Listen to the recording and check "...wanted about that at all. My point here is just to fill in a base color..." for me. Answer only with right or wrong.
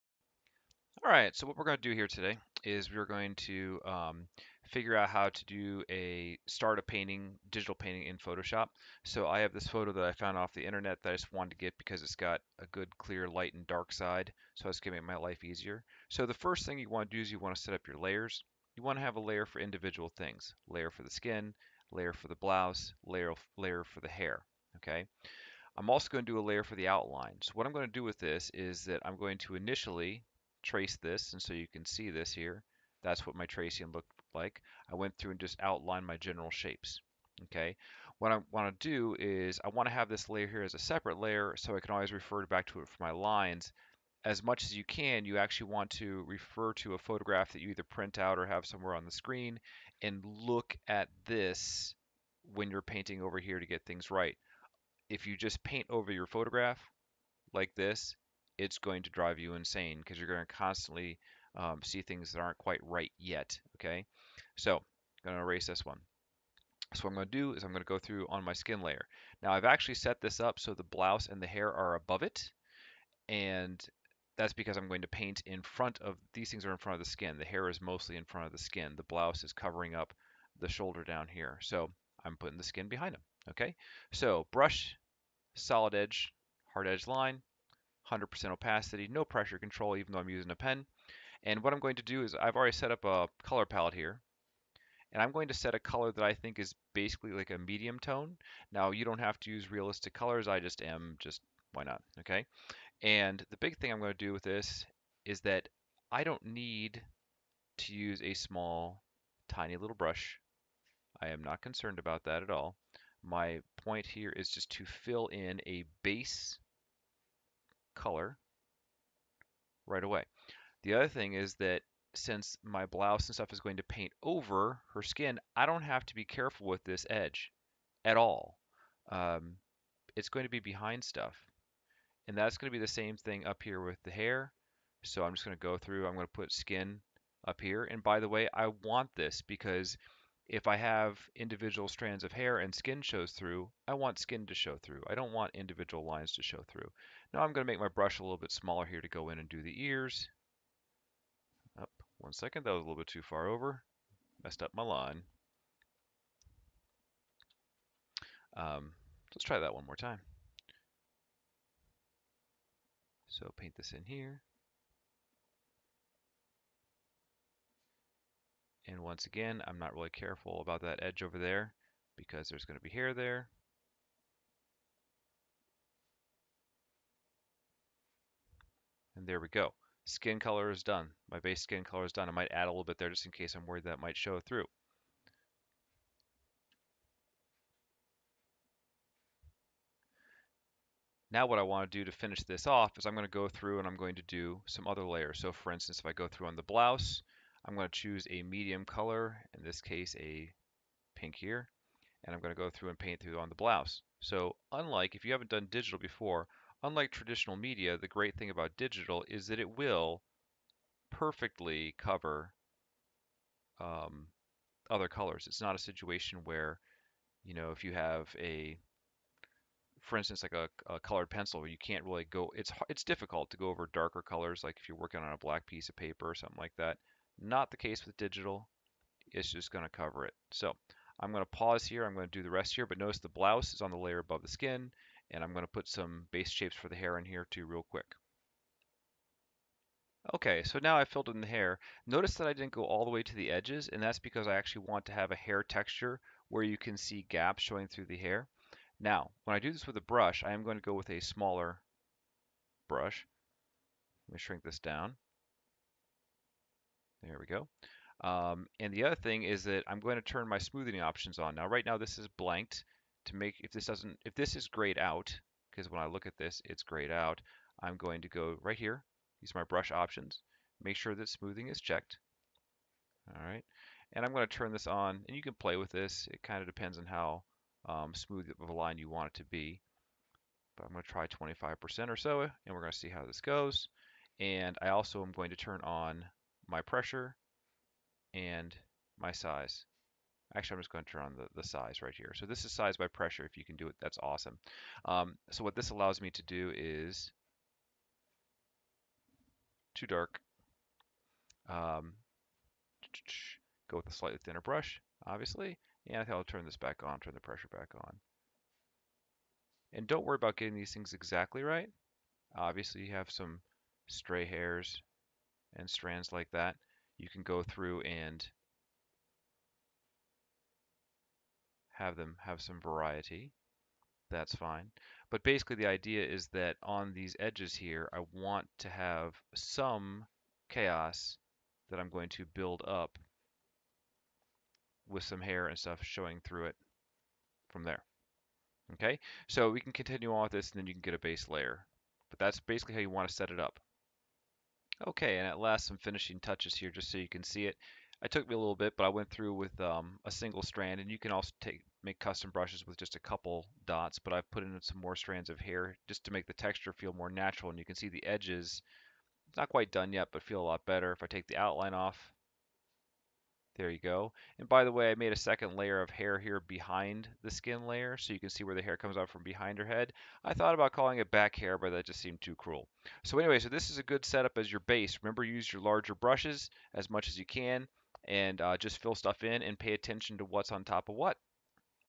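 wrong.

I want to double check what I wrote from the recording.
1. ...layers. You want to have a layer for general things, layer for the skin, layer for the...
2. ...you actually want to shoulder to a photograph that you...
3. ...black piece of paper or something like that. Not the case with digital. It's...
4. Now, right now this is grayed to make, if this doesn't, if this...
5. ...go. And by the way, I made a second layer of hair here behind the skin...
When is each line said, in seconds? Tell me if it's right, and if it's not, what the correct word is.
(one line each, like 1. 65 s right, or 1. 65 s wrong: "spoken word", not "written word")
1. 17 s wrong: "individual", not "general"
2. 45 s wrong: "refer", not "shoulder"
3. 225 s right
4. 261 s wrong: "blanked", not "grayed"
5. 363 s right.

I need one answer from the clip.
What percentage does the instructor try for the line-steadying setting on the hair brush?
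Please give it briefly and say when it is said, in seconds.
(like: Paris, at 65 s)
25%, at 281 s.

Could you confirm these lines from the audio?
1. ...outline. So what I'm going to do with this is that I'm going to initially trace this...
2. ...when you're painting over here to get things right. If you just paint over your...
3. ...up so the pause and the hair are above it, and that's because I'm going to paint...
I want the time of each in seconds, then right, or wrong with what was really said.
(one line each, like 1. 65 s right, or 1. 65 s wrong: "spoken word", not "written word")
1. 26 s right
2. 52 s right
3. 70 s wrong: "blouse", not "pause".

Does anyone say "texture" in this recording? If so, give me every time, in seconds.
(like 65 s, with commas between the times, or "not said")
245 s, 356 s.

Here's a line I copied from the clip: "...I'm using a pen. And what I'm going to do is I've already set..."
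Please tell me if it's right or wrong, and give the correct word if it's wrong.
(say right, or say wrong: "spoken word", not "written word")
right.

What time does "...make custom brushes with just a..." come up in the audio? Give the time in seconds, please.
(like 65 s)
352 s.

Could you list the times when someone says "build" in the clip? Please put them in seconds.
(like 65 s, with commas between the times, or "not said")
332 s.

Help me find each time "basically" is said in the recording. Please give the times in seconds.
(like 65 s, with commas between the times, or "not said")
96 s, 325 s, 342 s.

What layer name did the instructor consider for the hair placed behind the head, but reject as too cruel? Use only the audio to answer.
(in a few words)
Back hair.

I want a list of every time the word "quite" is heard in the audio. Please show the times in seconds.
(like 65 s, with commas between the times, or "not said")
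62 s, 359 s.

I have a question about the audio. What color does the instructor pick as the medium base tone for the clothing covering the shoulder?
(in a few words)
Pink.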